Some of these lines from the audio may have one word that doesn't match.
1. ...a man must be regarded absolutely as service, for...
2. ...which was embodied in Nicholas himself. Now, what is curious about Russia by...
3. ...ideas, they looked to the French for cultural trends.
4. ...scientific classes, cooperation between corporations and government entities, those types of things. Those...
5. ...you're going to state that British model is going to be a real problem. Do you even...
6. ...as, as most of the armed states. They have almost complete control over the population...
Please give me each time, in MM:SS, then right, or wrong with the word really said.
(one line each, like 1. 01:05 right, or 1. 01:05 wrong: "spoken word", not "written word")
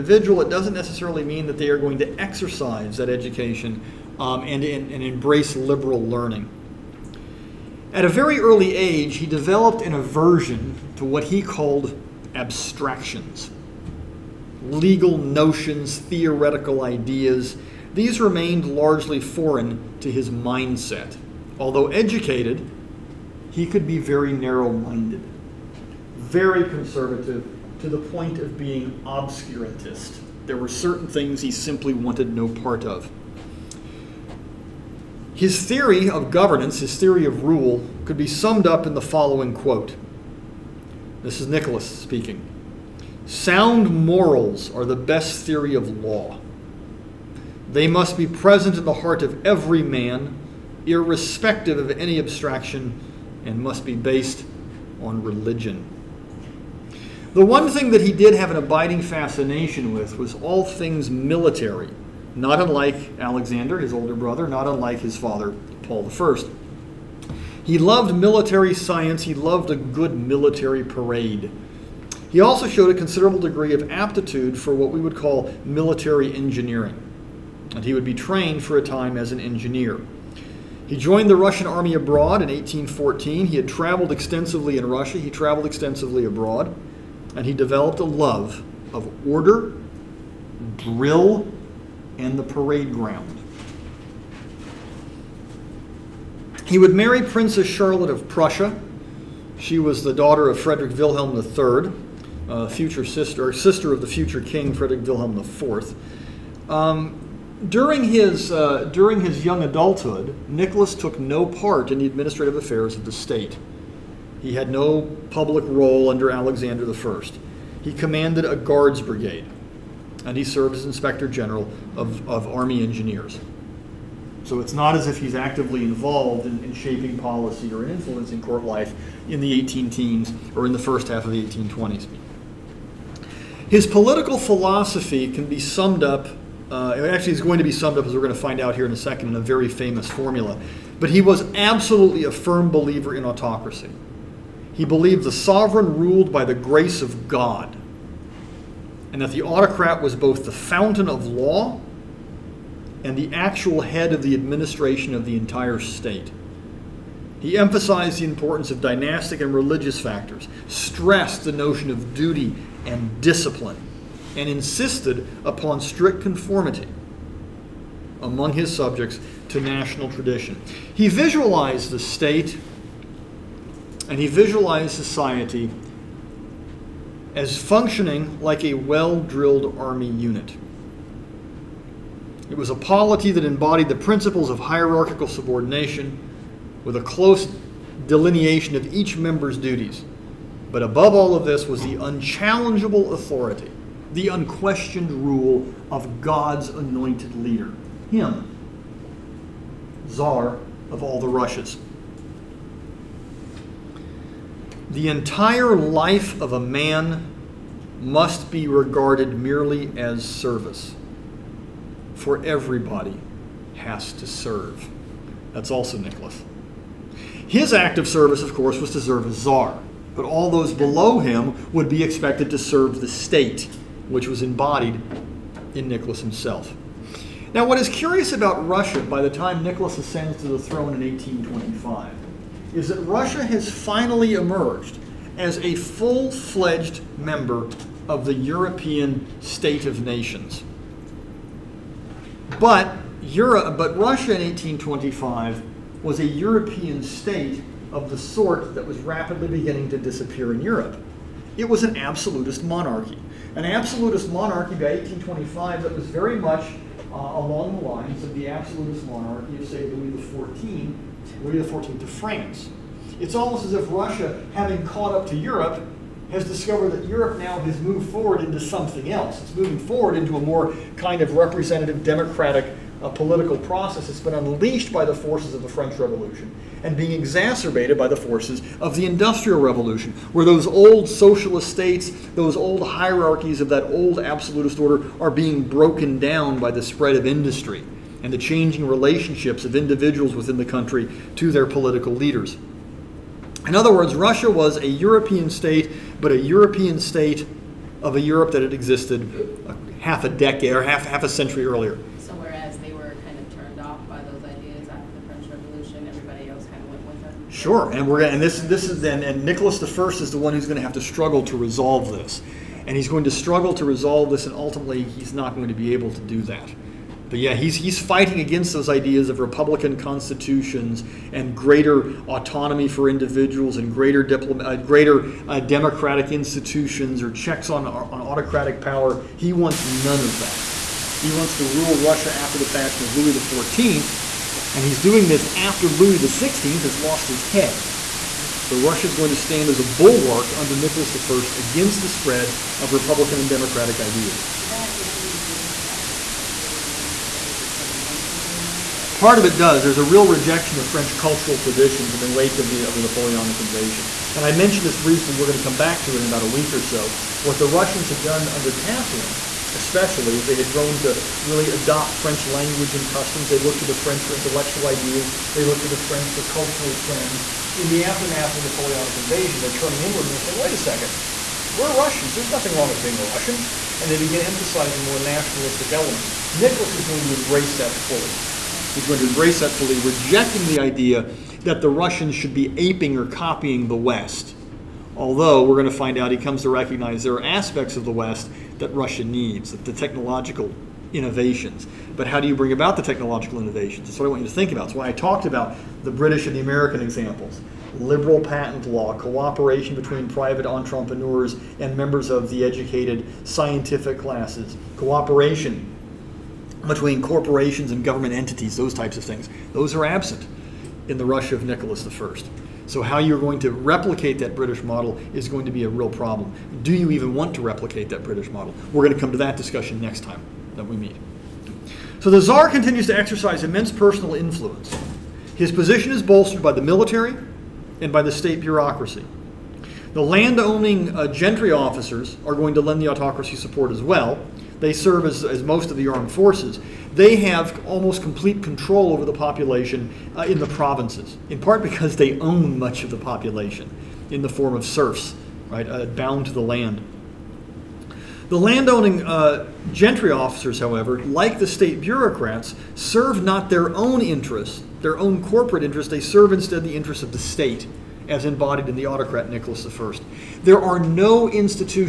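1. 03:26 wrong: "merely", not "absolutely"
2. 03:44 right
3. 06:04 right
4. 06:43 right
5. 06:53 wrong: "replicate", not "state"
6. 07:15 wrong: "forces", not "states".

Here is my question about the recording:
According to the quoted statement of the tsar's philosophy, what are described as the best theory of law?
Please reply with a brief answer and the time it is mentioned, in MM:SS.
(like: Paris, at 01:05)
Sound morals, at 00:43.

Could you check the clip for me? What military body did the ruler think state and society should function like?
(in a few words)
a well drilled army unit.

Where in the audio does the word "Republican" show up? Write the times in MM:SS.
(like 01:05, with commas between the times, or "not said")
05:19, 05:42.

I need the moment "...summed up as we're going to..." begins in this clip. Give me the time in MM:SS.
02:17.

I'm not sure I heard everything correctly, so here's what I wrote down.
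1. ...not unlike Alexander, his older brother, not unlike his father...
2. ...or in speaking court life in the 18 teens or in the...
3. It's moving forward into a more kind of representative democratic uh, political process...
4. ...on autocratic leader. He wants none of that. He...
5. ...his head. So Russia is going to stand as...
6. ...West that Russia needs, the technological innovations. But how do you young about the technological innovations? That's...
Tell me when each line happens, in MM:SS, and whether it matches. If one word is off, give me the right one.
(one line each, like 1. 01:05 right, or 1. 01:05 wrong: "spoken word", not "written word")
1. 01:02 right
2. 02:07 wrong: "influencing", not "speaking"
3. 04:29 right
4. 05:27 wrong: "power", not "leader"
5. 05:37 right
6. 06:28 wrong: "bring", not "young".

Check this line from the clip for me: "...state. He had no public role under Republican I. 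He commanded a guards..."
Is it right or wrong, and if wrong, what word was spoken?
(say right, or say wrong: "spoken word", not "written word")
wrong: "Alexander", not "Republican".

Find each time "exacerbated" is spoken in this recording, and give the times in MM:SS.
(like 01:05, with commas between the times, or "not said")
04:37.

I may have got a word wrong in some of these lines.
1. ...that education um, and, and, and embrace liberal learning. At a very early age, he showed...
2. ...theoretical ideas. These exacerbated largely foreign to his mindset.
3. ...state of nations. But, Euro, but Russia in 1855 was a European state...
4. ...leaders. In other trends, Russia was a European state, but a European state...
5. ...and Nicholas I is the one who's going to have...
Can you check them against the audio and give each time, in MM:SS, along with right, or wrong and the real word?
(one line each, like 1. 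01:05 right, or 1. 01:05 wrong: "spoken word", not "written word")
1. 00:02 wrong: "developed", not "showed"
2. 00:15 wrong: "remained", not "exacerbated"
3. 03:59 wrong: "1825", not "1855"
4. 04:52 wrong: "words", not "trends"
5. 05:09 right.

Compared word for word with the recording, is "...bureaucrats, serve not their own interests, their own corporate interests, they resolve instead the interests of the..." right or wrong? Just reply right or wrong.
wrong.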